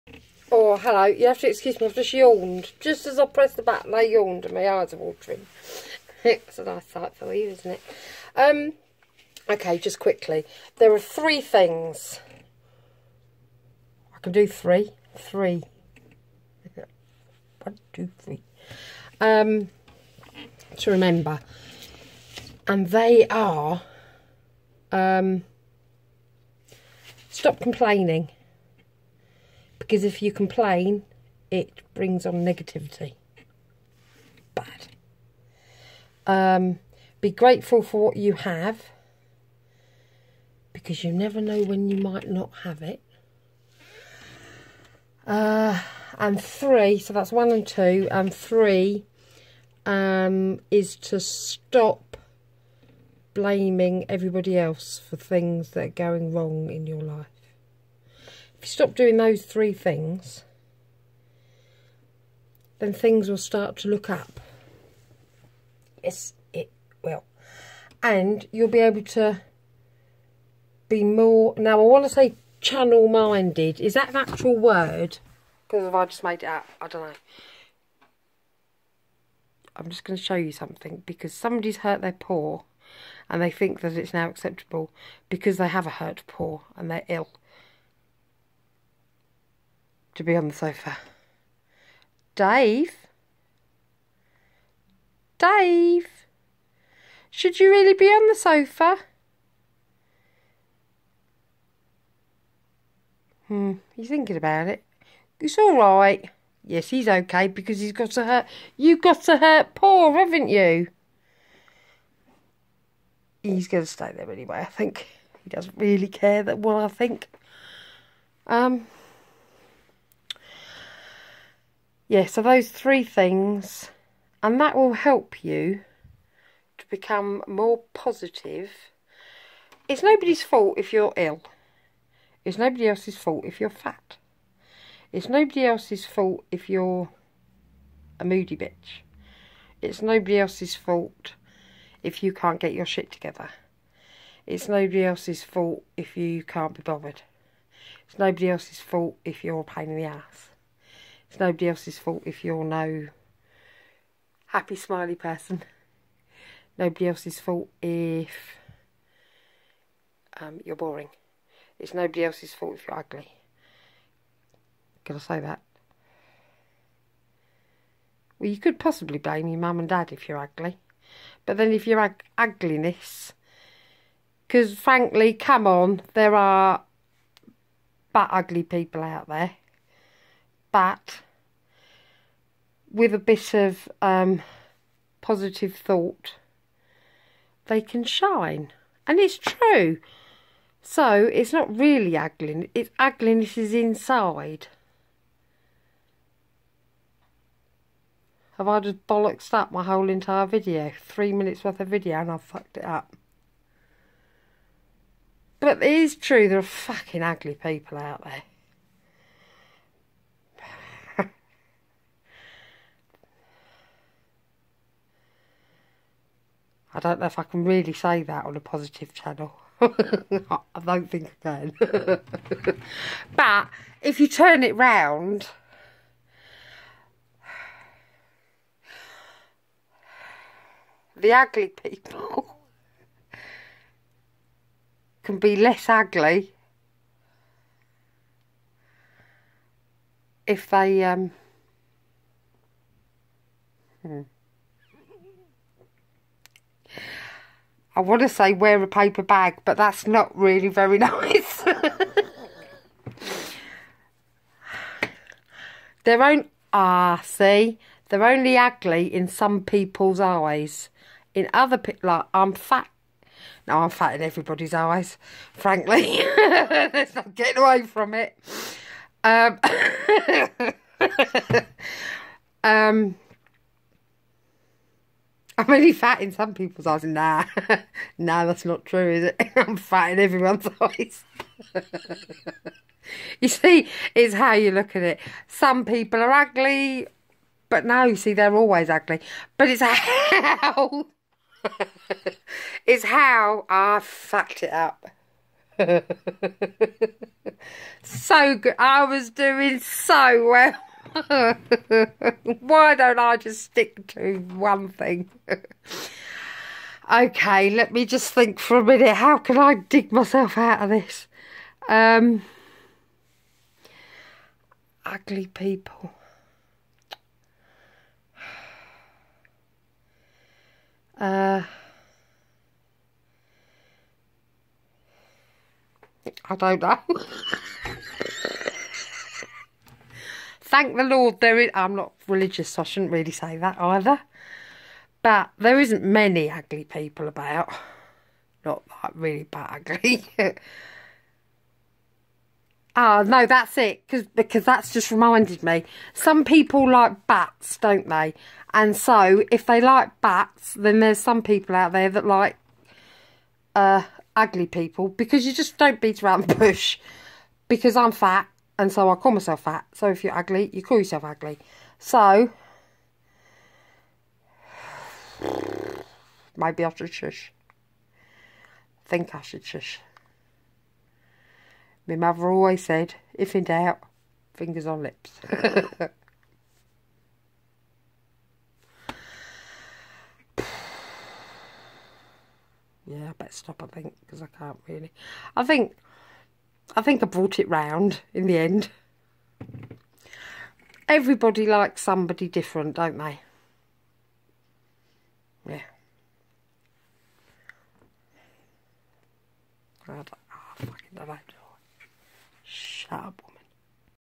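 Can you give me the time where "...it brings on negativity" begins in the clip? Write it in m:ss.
0:31.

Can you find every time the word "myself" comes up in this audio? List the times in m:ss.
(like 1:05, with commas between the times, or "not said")
5:10, 5:59.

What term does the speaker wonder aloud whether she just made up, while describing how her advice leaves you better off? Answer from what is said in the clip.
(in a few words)
channel-minded.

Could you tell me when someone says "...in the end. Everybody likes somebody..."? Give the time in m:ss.
6:28.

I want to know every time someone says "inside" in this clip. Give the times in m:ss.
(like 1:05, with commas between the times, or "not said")
3:13.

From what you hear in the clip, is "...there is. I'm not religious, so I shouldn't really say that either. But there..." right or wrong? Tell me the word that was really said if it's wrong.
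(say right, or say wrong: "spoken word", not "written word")
right.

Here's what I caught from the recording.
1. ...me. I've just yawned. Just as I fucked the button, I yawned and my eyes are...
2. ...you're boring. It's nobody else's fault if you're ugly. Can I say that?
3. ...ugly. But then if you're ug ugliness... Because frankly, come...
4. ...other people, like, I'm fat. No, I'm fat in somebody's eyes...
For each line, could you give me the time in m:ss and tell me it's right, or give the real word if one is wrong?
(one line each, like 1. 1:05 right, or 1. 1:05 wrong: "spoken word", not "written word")
1. 0:01 wrong: "pressed", not "fucked"
2. 2:40 right
3. 2:50 right
4. 4:21 wrong: "everybody", not "somebody".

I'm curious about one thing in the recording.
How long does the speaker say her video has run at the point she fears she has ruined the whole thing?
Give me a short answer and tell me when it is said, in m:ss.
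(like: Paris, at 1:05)
3 minutes, at 3:20.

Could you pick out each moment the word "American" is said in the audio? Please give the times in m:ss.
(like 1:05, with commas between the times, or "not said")
not said.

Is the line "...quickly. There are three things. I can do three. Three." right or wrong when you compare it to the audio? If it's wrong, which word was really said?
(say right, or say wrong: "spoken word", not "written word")
right.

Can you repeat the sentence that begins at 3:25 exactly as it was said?
But it is true, there are fucking ugly people out there.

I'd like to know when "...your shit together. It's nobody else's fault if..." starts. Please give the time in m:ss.
2:22.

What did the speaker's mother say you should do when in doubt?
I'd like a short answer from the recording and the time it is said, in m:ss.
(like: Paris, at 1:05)
fingers on lips, at 6:14.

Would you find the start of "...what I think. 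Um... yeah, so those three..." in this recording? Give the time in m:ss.
1:56.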